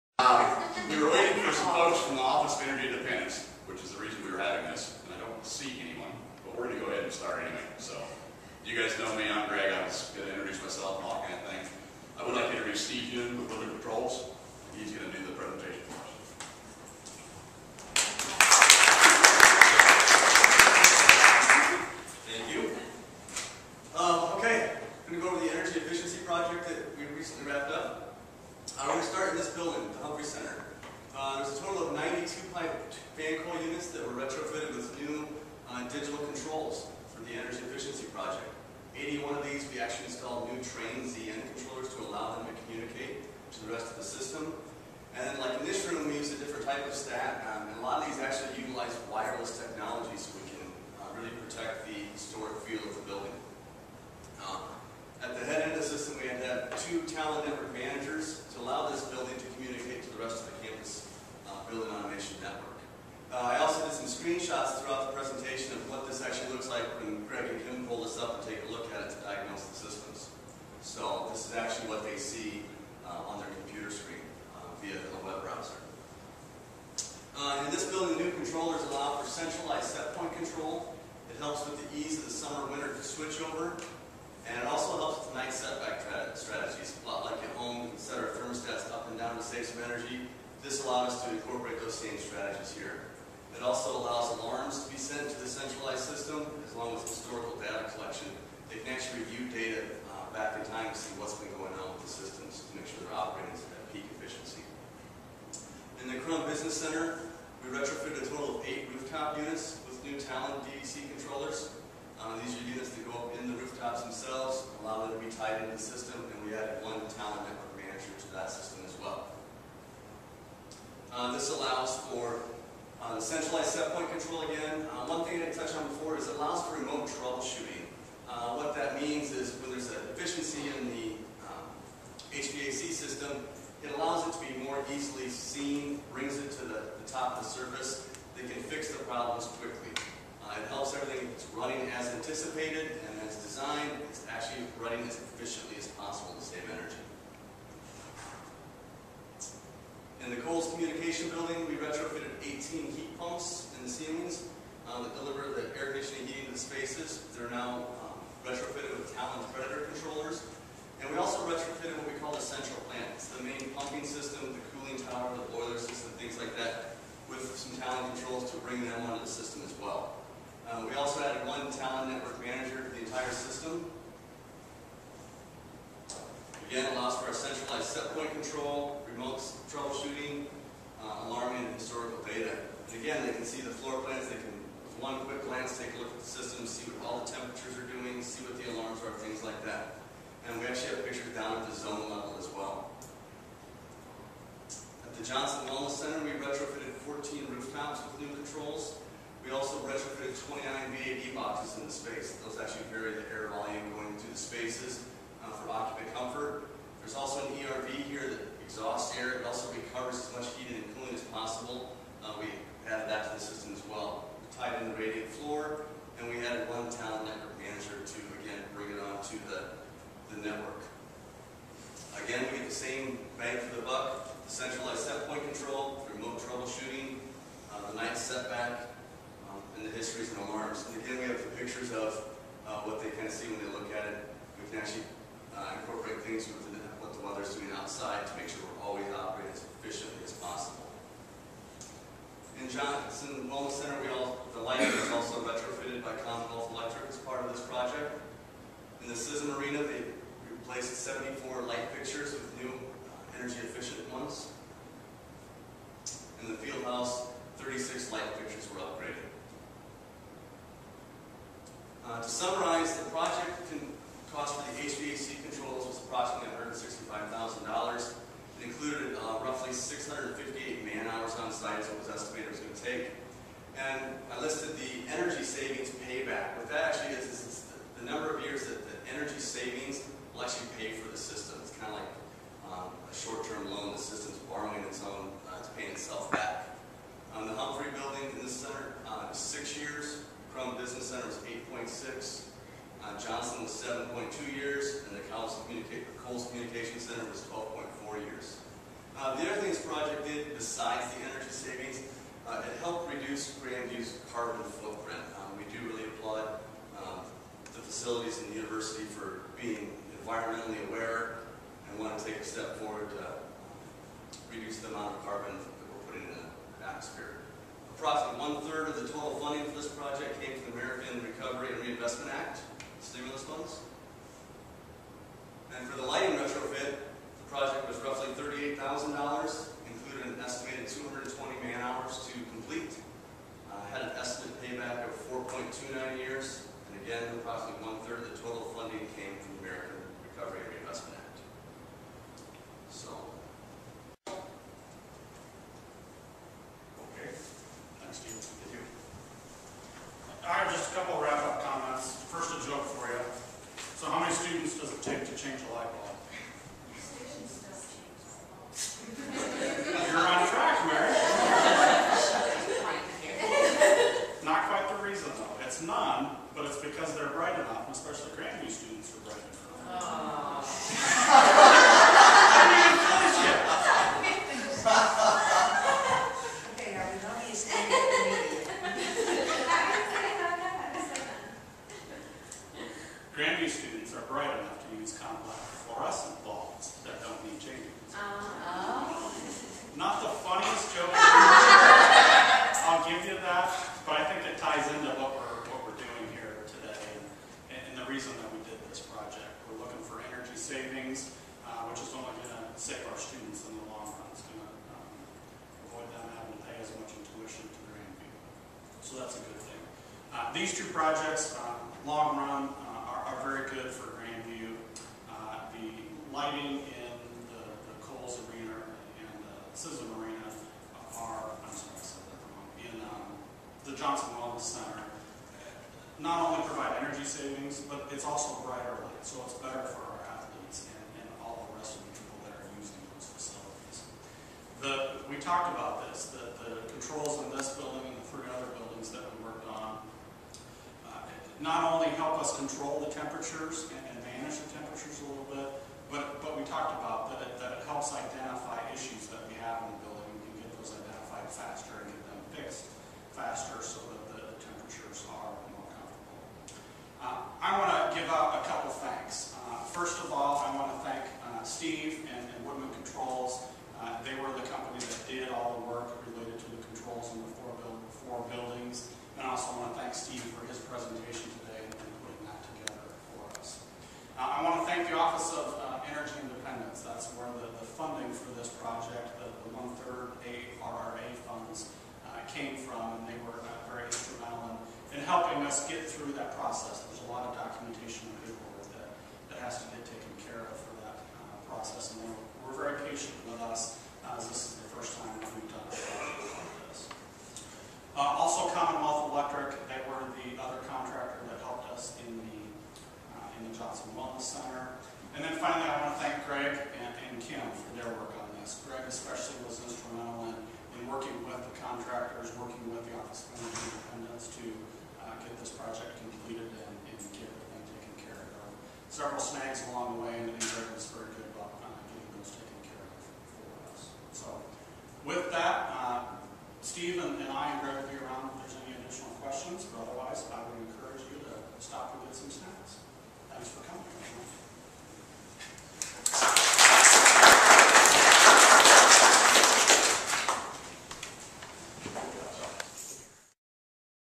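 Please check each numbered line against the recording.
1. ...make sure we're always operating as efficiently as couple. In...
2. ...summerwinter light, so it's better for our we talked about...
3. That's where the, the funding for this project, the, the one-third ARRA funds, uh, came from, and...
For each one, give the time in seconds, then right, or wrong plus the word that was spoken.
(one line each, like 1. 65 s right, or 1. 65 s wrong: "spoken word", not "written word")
1. 238 s wrong: "possible", not "couple"
2. 428 s wrong: "brighter", not "summerwinter"
3. 477 s right.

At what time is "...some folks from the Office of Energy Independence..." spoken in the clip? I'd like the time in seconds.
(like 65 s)
1 s.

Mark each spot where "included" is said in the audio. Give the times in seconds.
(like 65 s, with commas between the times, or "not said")
268 s.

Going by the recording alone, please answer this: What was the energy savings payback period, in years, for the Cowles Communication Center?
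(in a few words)
12.4 years.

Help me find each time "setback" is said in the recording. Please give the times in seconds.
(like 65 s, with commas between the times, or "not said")
85 s, 228 s.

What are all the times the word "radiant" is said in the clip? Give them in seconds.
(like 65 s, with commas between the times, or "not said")
214 s.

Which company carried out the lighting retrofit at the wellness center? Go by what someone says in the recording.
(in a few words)
Commonwealth Electric.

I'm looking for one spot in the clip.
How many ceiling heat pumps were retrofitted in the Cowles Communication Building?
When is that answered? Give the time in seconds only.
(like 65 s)
152 s.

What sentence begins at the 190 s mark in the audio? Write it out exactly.
And we actually have pictures down at the zone level as well.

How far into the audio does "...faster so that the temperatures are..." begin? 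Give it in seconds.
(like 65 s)
453 s.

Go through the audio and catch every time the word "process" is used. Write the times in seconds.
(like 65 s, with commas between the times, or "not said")
486 s, 491 s.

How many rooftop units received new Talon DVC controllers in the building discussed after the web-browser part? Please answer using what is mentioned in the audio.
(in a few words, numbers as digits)
8.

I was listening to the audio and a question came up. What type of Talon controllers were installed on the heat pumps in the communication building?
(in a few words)
Talon Predator.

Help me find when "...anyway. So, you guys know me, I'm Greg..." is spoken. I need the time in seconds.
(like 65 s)
7 s.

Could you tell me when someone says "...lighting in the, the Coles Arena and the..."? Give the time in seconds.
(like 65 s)
416 s.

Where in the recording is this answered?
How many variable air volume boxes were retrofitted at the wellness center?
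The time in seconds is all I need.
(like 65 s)
200 s.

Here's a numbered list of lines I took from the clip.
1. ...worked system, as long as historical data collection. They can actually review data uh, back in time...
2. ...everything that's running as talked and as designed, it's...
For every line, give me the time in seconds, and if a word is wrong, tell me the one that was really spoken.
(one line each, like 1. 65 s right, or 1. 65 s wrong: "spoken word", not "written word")
1. 95 s wrong: "centralized", not "worked"
2. 140 s wrong: "anticipated", not "talked".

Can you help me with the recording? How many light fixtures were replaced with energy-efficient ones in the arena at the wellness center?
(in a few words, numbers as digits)
74.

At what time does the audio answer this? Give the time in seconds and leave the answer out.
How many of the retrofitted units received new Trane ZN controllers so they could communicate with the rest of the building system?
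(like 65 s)
38 s.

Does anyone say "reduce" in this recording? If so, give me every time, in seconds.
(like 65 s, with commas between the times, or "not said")
303 s, 314 s.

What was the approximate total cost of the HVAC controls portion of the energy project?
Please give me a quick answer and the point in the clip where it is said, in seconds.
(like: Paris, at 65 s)
$165,000, at 266 s.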